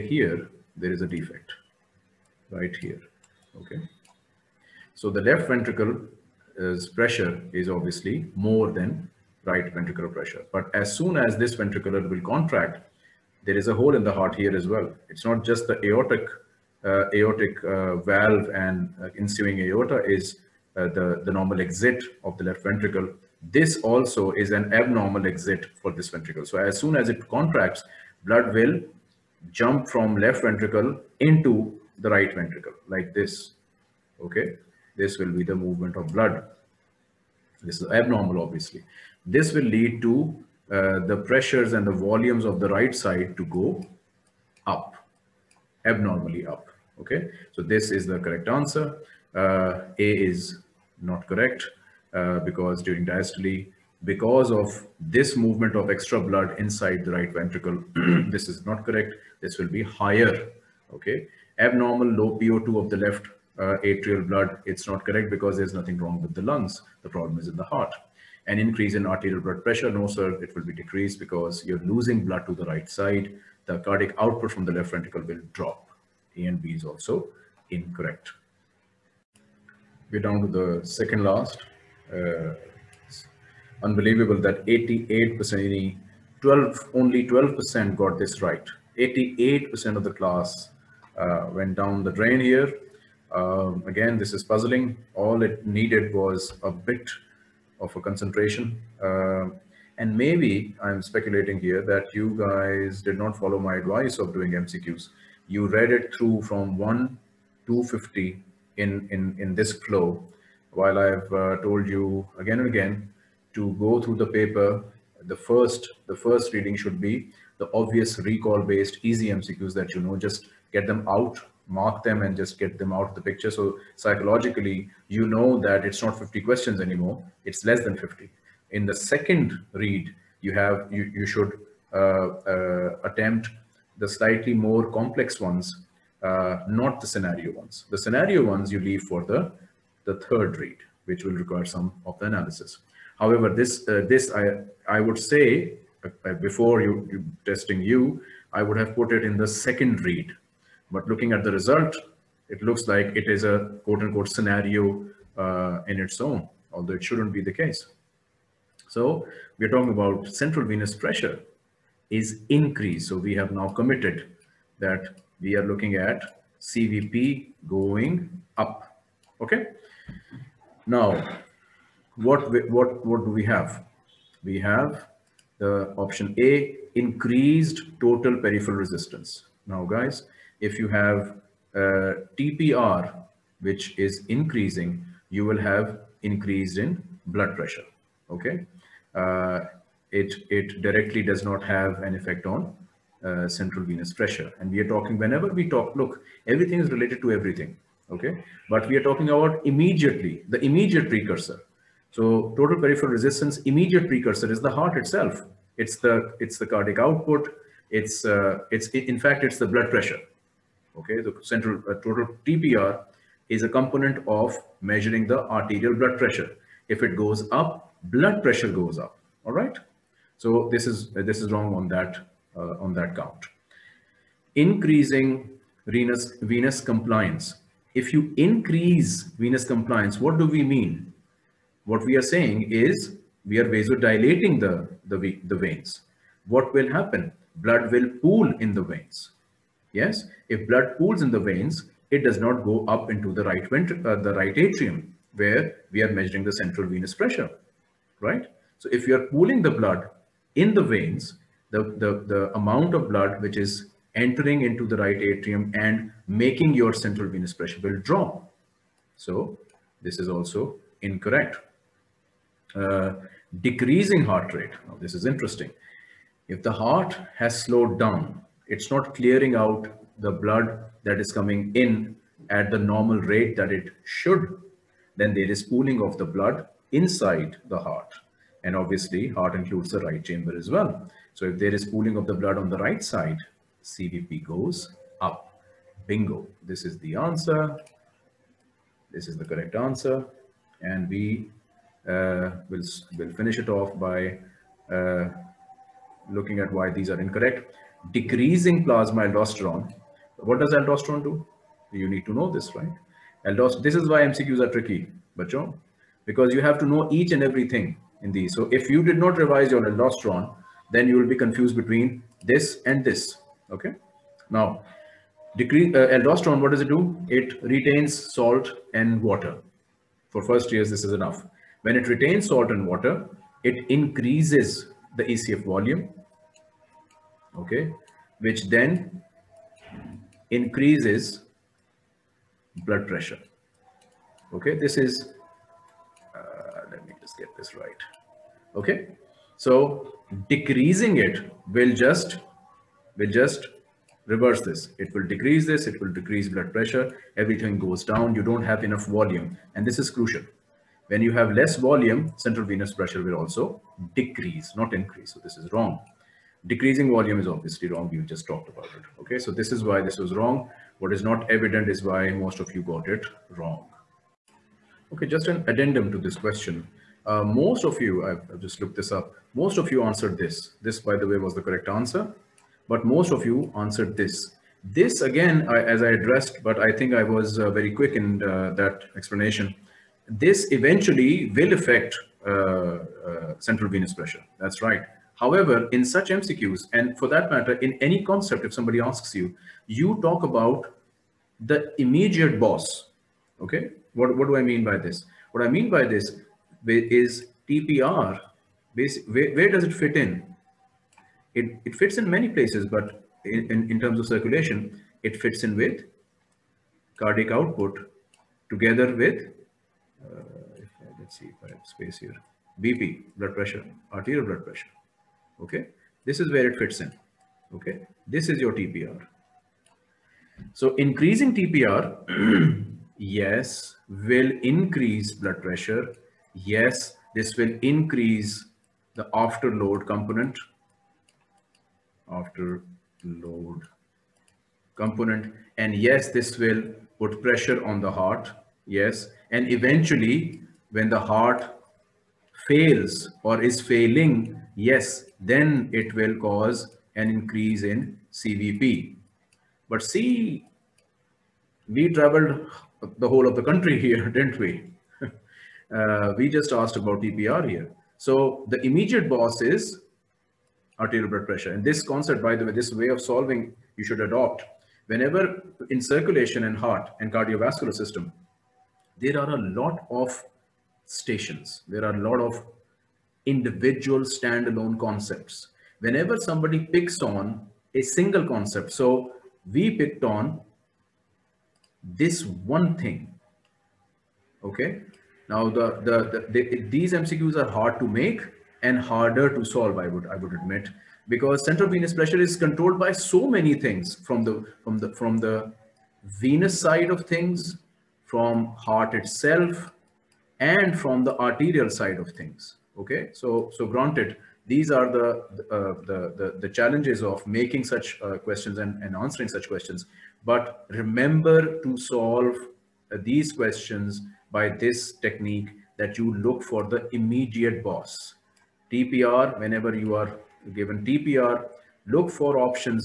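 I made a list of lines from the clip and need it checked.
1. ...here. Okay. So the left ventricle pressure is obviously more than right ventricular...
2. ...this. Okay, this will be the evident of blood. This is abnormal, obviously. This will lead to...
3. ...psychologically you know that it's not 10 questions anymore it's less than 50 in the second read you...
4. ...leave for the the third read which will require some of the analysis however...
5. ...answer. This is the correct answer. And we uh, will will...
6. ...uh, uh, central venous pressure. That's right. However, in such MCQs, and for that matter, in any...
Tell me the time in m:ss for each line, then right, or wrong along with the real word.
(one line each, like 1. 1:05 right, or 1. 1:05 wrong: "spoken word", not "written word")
1. 0:02 right
2. 0:33 wrong: "movement", not "evident"
3. 2:03 wrong: "50", not "10"
4. 2:18 right
5. 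4:47 right
6. 6:22 right.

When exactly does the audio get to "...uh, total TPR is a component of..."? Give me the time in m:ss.
3:31.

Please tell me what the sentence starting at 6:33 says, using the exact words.
Okay, what, what do I mean by this?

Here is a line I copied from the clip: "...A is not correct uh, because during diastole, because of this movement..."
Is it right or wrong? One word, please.
right.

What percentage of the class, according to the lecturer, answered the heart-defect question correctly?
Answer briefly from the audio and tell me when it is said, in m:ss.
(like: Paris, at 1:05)
12%, at 1:26.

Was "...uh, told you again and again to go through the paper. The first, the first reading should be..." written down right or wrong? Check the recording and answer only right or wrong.
right.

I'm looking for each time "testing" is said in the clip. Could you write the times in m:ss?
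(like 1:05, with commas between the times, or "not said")
2:27.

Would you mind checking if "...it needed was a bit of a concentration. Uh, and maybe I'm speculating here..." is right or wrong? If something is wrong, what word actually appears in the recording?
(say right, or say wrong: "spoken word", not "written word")
right.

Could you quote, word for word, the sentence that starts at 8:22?
Okay, so so granted, these are the uh, the, the, the challenges of making such uh, questions and, and answering such questions.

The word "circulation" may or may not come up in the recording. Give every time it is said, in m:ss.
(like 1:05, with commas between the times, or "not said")
6:44, 7:46.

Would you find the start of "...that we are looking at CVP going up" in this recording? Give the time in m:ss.
2:44.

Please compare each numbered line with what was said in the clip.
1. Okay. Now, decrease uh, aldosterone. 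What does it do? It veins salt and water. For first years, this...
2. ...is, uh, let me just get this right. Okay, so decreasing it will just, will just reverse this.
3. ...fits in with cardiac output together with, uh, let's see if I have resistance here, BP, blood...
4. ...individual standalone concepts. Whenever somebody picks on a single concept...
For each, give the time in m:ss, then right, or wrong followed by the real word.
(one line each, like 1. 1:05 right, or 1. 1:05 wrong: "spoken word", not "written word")
1. 5:13 wrong: "retains", not "veins"
2. 5:34 right
3. 6:45 wrong: "space", not "resistance"
4. 7:53 right.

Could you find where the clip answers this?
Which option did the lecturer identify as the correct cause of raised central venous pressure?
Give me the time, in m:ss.
4:23.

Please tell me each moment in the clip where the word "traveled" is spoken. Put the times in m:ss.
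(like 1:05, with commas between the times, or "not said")
7:32.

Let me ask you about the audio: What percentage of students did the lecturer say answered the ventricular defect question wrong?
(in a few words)
88%.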